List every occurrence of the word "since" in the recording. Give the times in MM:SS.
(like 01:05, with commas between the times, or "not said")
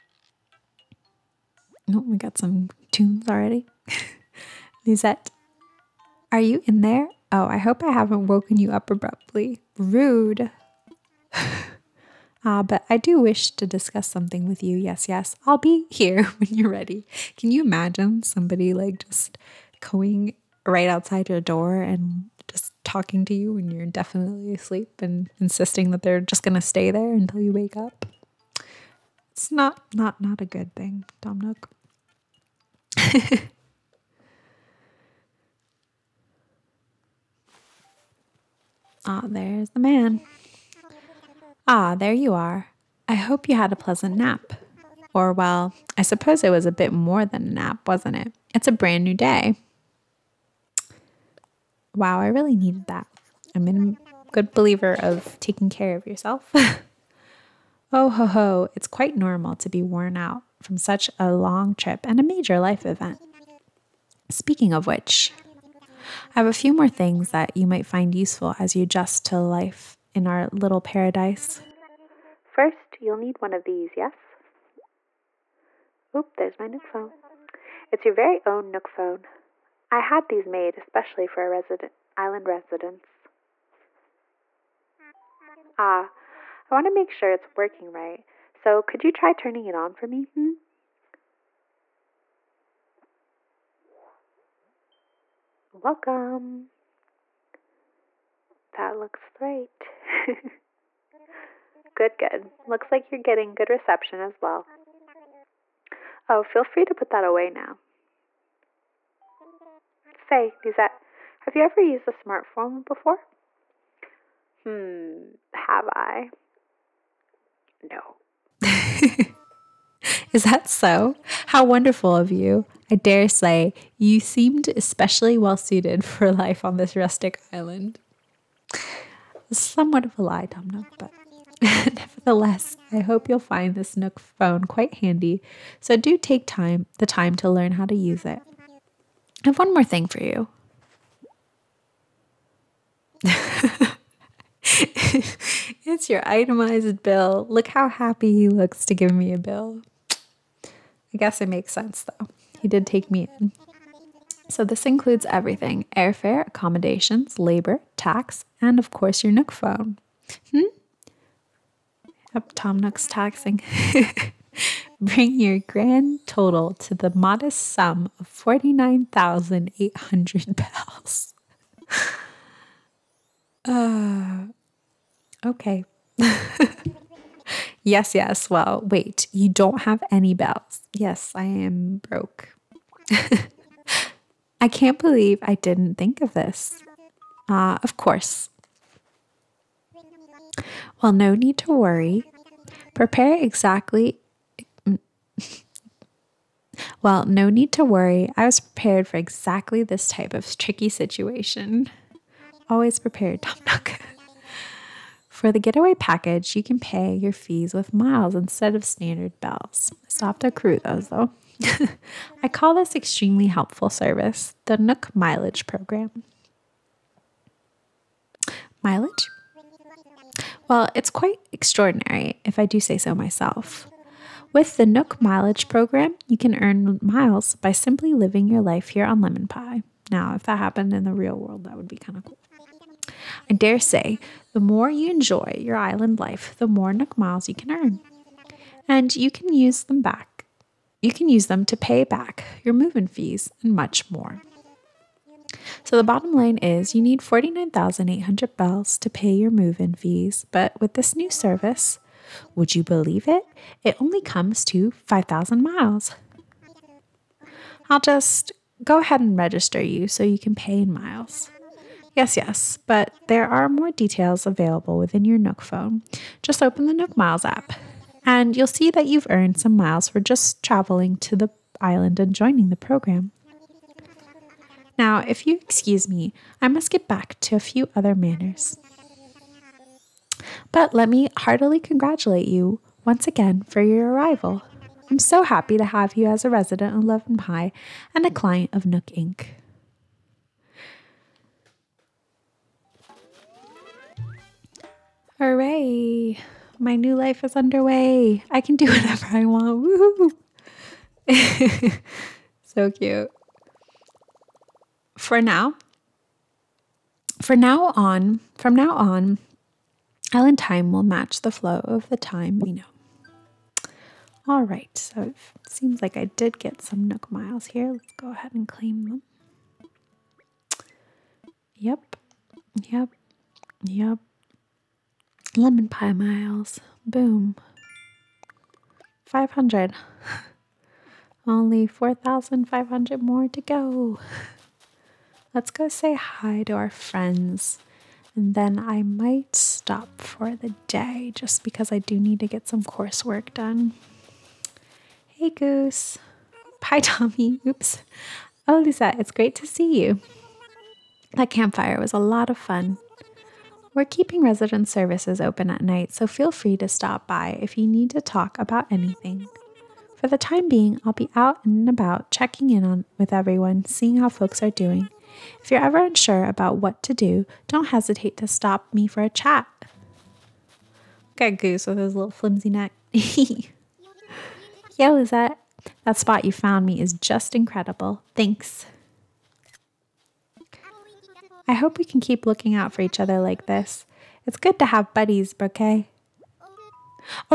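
not said.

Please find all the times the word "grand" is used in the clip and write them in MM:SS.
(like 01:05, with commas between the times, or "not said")
02:45.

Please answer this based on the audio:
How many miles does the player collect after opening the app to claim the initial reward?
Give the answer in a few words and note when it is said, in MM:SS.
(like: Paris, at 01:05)
500, at 05:29.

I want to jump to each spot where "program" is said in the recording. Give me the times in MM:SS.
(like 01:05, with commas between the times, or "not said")
03:35, 03:45, 04:32.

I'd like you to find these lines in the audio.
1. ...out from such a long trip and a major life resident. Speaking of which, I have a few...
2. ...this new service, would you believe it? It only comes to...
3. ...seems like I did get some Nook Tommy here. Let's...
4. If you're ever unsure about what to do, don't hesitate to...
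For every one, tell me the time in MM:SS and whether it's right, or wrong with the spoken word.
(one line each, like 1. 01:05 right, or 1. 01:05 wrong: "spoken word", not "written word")
1. 01:00 wrong: "event", not "resident"
2. 04:10 right
3. 05:15 wrong: "Miles", not "Tommy"
4. 06:05 right.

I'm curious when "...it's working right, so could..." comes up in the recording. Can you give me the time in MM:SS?
01:27.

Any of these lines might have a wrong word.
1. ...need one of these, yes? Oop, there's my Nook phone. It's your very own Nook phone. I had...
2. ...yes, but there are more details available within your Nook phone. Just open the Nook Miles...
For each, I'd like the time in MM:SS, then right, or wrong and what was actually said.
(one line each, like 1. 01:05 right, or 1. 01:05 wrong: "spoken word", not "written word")
1. 01:13 right
2. 04:22 right.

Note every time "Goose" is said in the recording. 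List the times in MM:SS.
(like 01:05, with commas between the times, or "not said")
05:45, 06:11.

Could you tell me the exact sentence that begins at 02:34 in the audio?
So this includes everything airfare, accommodations, labor, tax, and of course your Nook phone.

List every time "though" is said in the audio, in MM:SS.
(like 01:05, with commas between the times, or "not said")
02:32, 03:31.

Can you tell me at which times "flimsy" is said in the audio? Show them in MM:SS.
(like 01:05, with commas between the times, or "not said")
06:12.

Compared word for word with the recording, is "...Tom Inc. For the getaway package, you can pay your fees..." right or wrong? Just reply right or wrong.
wrong.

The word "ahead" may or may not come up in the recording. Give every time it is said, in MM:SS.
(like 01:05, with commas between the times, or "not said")
04:19, 05:18.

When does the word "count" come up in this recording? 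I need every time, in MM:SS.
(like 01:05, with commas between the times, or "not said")
not said.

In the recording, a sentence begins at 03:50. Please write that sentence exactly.
Now, if that happened in the real world, that would be kind of cool.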